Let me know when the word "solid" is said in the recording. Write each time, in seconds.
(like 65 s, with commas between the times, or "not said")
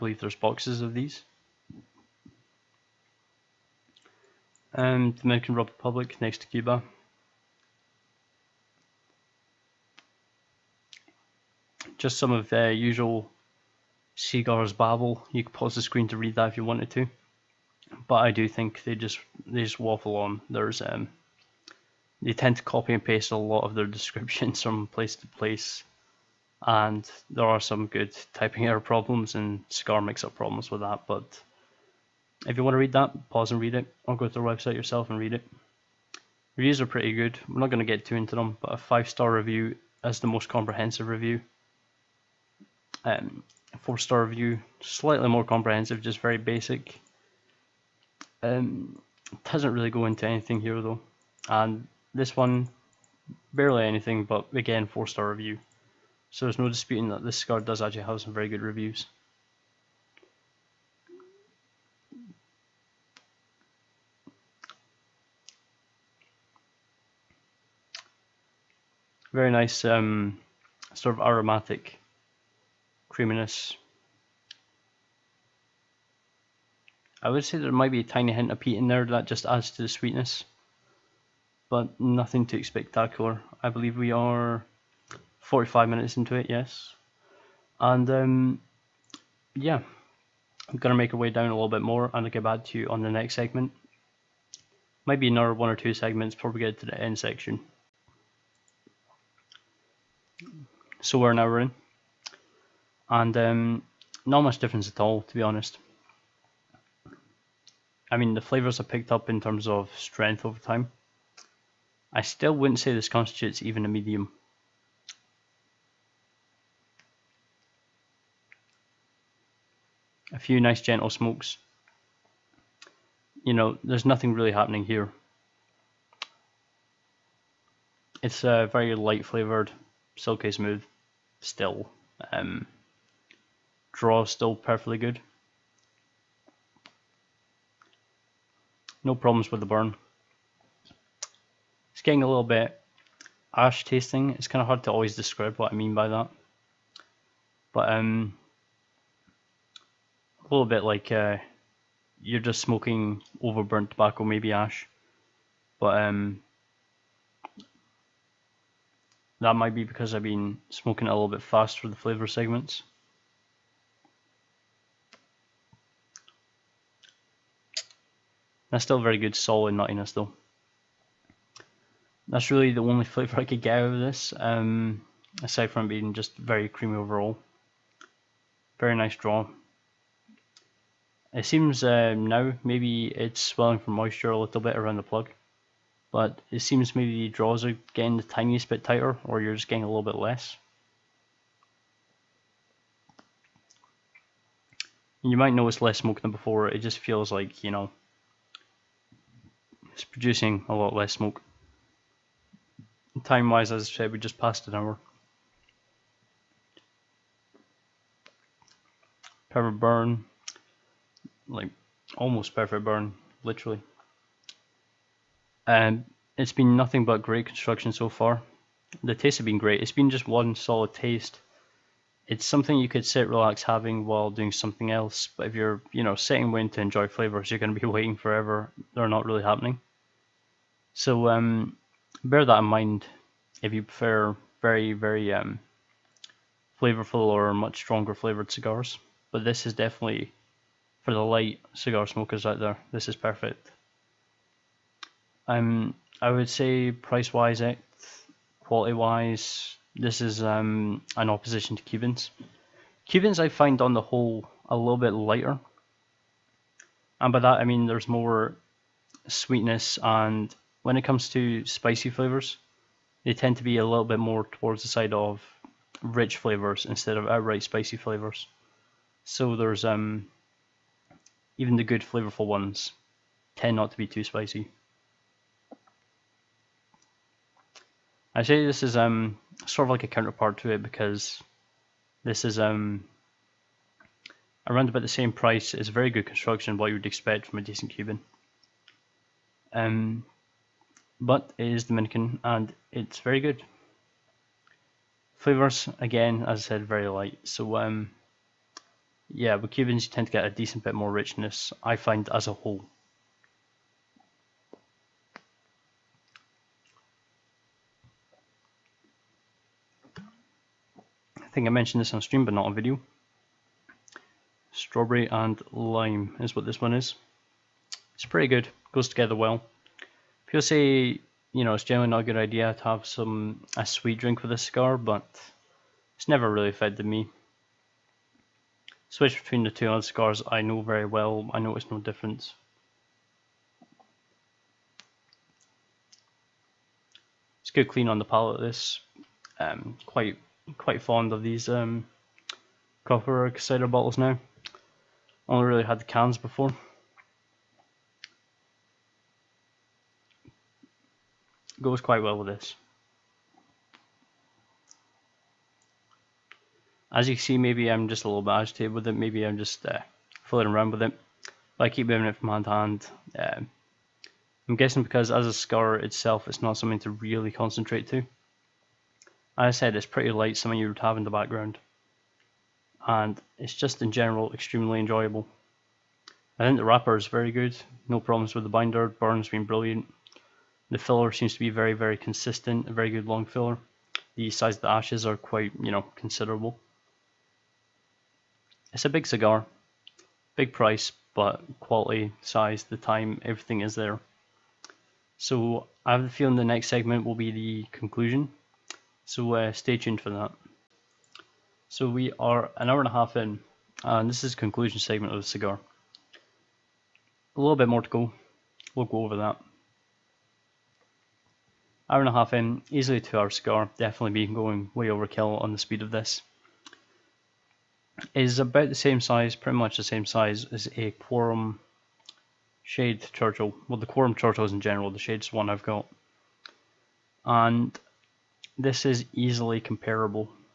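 169 s, 220 s.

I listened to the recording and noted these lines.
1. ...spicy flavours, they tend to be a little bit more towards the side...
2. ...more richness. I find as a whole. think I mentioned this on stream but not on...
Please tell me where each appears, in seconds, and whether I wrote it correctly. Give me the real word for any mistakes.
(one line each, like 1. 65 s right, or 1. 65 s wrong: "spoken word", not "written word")
1. 261 s right
2. 300 s right.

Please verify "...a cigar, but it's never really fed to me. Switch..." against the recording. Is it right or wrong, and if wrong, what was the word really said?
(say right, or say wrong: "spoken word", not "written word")
right.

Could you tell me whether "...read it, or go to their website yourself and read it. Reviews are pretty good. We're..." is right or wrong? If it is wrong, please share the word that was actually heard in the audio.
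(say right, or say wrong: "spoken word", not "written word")
right.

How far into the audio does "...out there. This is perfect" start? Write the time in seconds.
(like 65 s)
242 s.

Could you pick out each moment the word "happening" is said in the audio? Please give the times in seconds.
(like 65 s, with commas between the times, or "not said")
124 s, 229 s.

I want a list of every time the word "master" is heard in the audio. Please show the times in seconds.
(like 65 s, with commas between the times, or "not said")
not said.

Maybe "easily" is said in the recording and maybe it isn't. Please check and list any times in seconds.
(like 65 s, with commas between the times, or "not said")
412 s, 429 s.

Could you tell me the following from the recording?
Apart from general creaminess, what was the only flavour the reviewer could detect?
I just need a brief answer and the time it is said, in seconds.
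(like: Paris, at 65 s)
Nuttiness, at 169 s.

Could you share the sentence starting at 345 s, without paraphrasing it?
only really had the cans before.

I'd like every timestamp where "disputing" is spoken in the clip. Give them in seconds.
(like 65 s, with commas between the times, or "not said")
56 s.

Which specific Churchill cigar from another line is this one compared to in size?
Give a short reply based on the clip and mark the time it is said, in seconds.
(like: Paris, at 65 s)
Quorum Shade Churchill, at 421 s.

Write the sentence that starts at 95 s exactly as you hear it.
Maybe another one or two segments before we get to the end section.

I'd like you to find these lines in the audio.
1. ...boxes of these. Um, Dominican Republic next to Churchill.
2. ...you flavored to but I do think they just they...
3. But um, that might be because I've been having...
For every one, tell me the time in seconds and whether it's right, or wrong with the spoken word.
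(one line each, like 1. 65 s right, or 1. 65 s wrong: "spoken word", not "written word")
1. 0 s wrong: "Cuba", not "Churchill"
2. 16 s wrong: "wanted", not "flavored"
3. 155 s wrong: "smoking", not "having".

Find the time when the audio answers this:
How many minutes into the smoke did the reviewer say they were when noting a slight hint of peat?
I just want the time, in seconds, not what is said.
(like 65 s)
85 s.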